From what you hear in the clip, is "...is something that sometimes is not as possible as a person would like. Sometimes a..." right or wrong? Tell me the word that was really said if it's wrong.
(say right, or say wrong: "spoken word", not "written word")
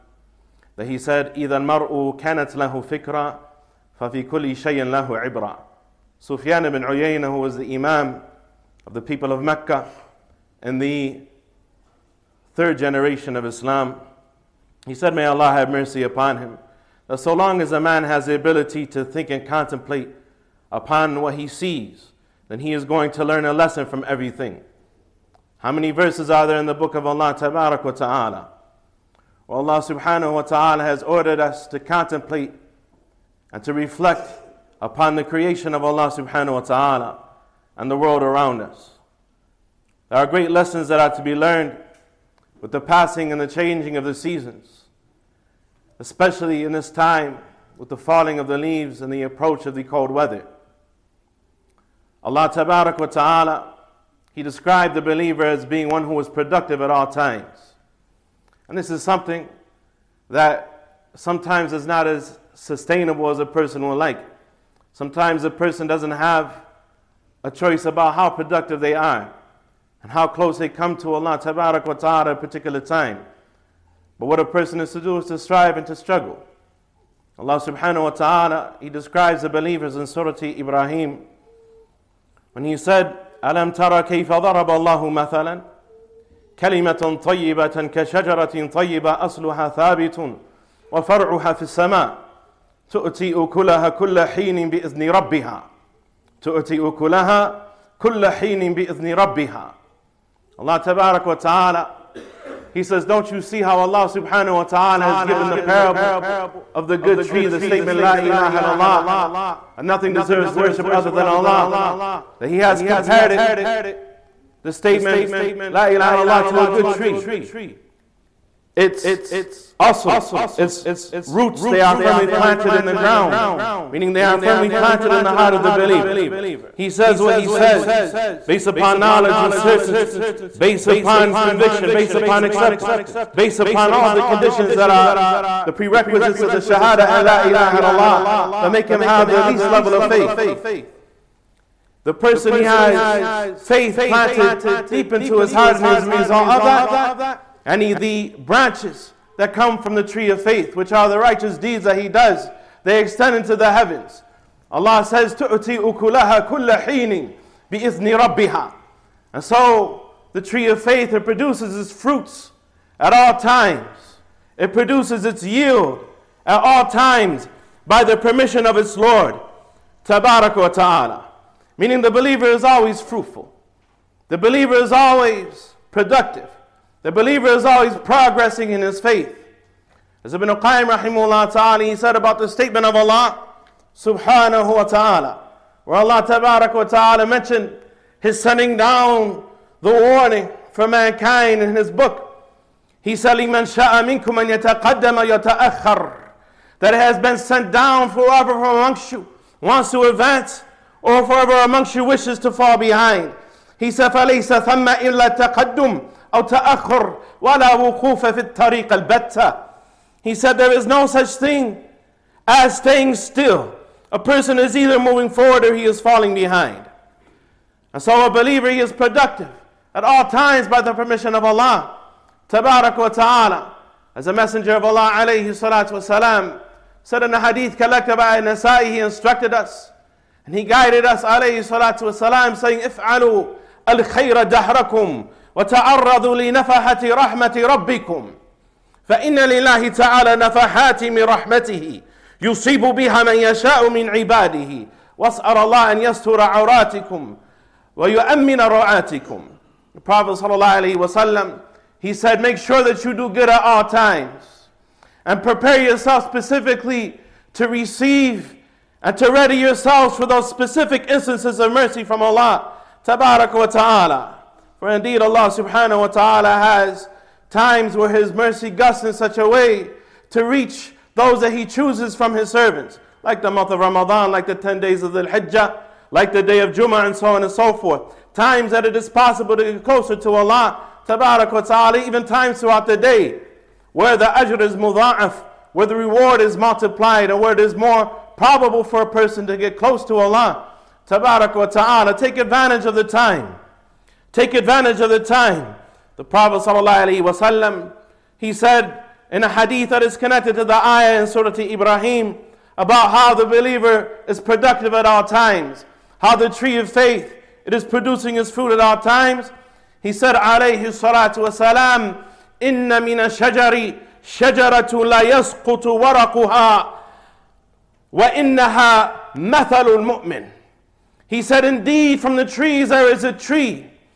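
wrong: "sustainable", not "possible".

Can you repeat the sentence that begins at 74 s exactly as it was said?
But what a person is to do is to strive and to struggle.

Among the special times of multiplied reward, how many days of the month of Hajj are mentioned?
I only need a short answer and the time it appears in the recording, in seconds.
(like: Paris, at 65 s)
10, at 274 s.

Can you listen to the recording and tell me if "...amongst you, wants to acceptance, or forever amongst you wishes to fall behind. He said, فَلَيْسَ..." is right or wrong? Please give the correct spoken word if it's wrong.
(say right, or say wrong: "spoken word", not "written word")
wrong: "advance", not "acceptance".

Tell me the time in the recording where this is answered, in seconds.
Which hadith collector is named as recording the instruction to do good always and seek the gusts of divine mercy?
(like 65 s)
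228 s.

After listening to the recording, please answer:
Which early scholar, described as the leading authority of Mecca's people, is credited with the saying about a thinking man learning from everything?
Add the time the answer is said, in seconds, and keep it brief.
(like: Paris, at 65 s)
Sufyan ibn Uyayna, at 6 s.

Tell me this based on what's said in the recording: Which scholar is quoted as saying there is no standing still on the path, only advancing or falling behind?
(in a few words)
Ibn Qayyim.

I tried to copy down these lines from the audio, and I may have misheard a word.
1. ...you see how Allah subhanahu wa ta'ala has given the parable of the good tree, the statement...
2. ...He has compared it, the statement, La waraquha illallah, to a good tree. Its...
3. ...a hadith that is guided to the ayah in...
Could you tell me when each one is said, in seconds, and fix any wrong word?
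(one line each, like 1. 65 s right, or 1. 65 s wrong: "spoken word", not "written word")
1. 103 s right
2. 112 s wrong: "ilaha", not "waraquha"
3. 299 s wrong: "connected", not "guided".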